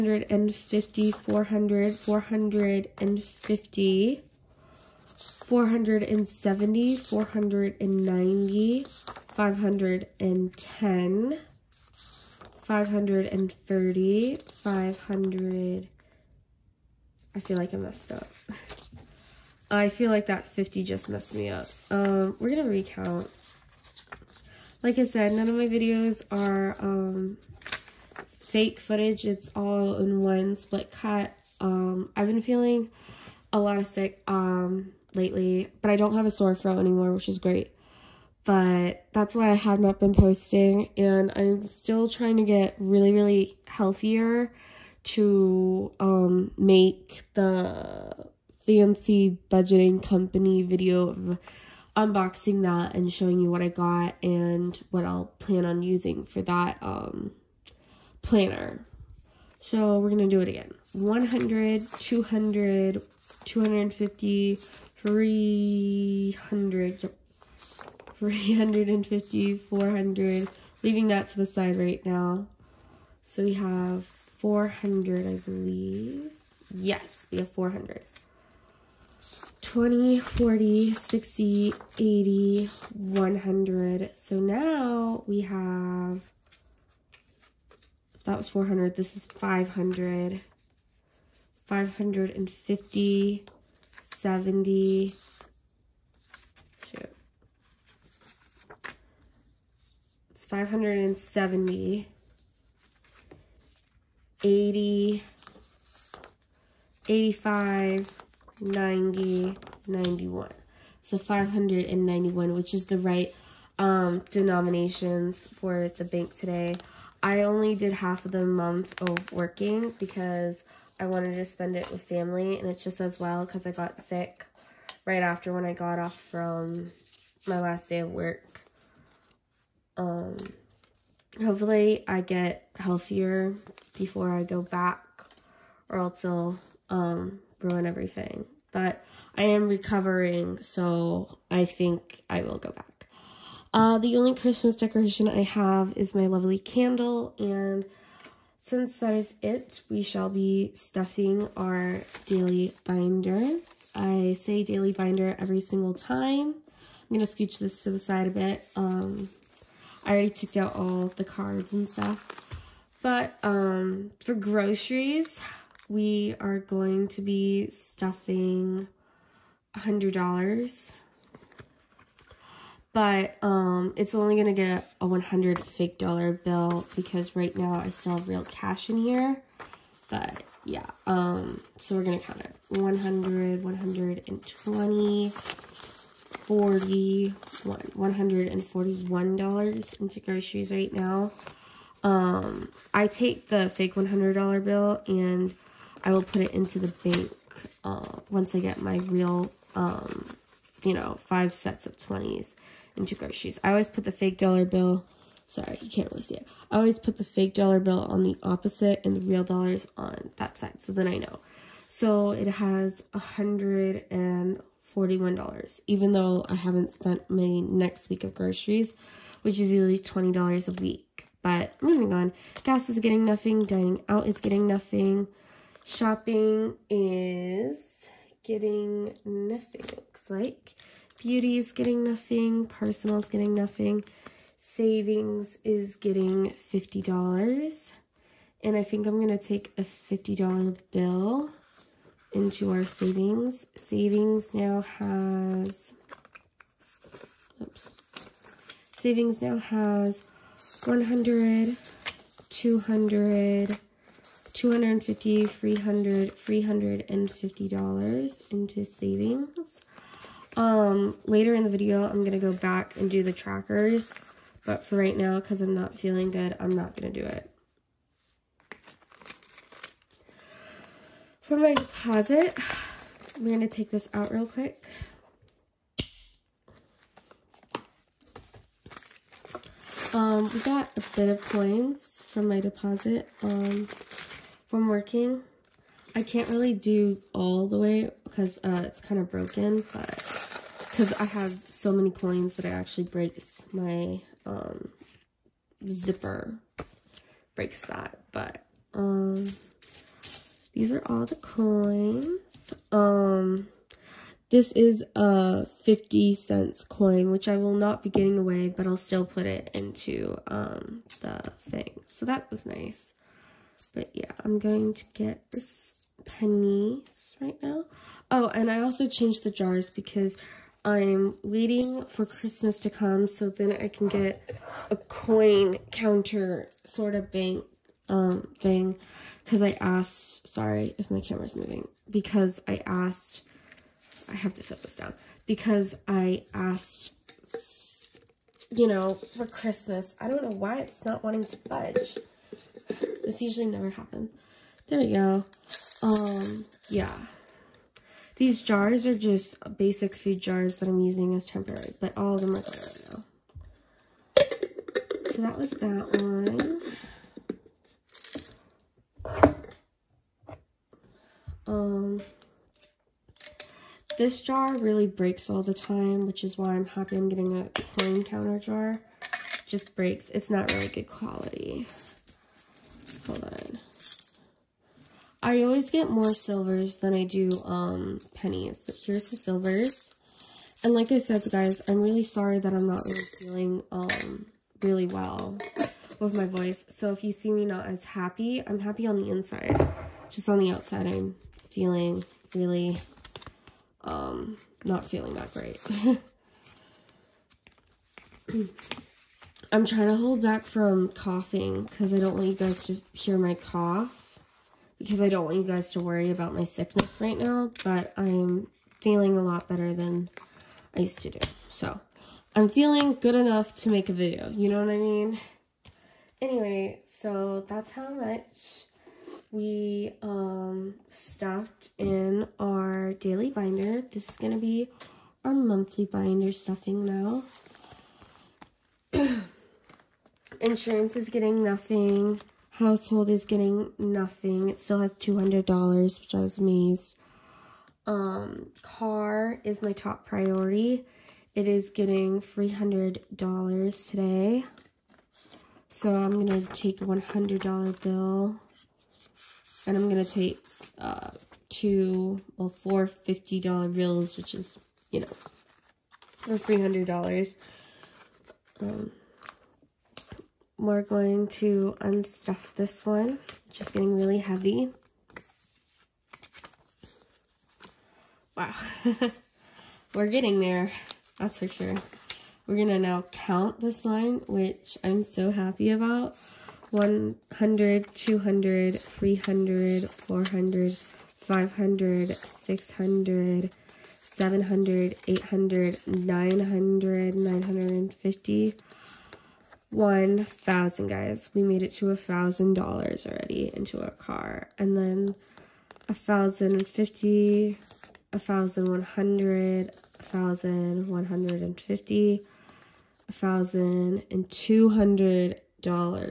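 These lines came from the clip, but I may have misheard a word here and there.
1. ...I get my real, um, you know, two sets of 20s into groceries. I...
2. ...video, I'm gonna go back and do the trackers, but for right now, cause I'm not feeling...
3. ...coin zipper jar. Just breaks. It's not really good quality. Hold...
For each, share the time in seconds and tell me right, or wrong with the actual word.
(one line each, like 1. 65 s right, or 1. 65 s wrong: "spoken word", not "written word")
1. 198 s wrong: "five", not "two"
2. 261 s right
3. 367 s wrong: "counter", not "zipper".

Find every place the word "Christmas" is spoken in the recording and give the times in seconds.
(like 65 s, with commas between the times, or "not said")
144 s, 322 s, 339 s.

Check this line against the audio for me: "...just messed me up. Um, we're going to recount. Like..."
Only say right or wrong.
right.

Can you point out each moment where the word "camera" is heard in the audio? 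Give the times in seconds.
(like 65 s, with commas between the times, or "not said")
331 s.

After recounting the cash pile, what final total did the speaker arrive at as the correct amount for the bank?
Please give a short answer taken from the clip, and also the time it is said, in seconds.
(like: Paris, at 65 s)
591, at 111 s.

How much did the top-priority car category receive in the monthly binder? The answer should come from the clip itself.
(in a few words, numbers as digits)
$300.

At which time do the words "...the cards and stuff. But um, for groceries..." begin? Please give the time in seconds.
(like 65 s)
161 s.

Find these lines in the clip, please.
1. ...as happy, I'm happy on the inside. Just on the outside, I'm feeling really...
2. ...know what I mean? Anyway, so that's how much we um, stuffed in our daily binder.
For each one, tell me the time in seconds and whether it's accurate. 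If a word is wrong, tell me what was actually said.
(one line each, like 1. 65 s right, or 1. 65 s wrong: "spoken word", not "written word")
1. 387 s right
2. 414 s right.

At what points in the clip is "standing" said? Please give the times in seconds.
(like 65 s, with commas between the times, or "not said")
not said.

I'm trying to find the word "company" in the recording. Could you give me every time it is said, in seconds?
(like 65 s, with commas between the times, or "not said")
50 s.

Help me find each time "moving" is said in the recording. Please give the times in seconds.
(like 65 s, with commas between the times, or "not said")
221 s, 331 s.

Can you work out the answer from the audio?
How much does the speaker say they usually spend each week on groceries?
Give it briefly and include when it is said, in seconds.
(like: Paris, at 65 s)
$20, at 219 s.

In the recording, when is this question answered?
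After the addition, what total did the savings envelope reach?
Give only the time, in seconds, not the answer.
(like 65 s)
256 s.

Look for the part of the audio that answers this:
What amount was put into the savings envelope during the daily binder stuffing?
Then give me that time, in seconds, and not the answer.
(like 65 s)
234 s.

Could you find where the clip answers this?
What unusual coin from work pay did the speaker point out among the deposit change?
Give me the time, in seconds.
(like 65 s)
305 s.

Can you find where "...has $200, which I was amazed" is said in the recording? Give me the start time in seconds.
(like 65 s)
435 s.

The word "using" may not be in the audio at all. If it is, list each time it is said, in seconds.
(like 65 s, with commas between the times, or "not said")
55 s, 351 s.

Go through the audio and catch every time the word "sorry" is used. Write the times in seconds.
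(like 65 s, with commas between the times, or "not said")
205 s, 330 s, 382 s.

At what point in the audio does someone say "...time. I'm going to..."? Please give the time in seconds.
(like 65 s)
155 s.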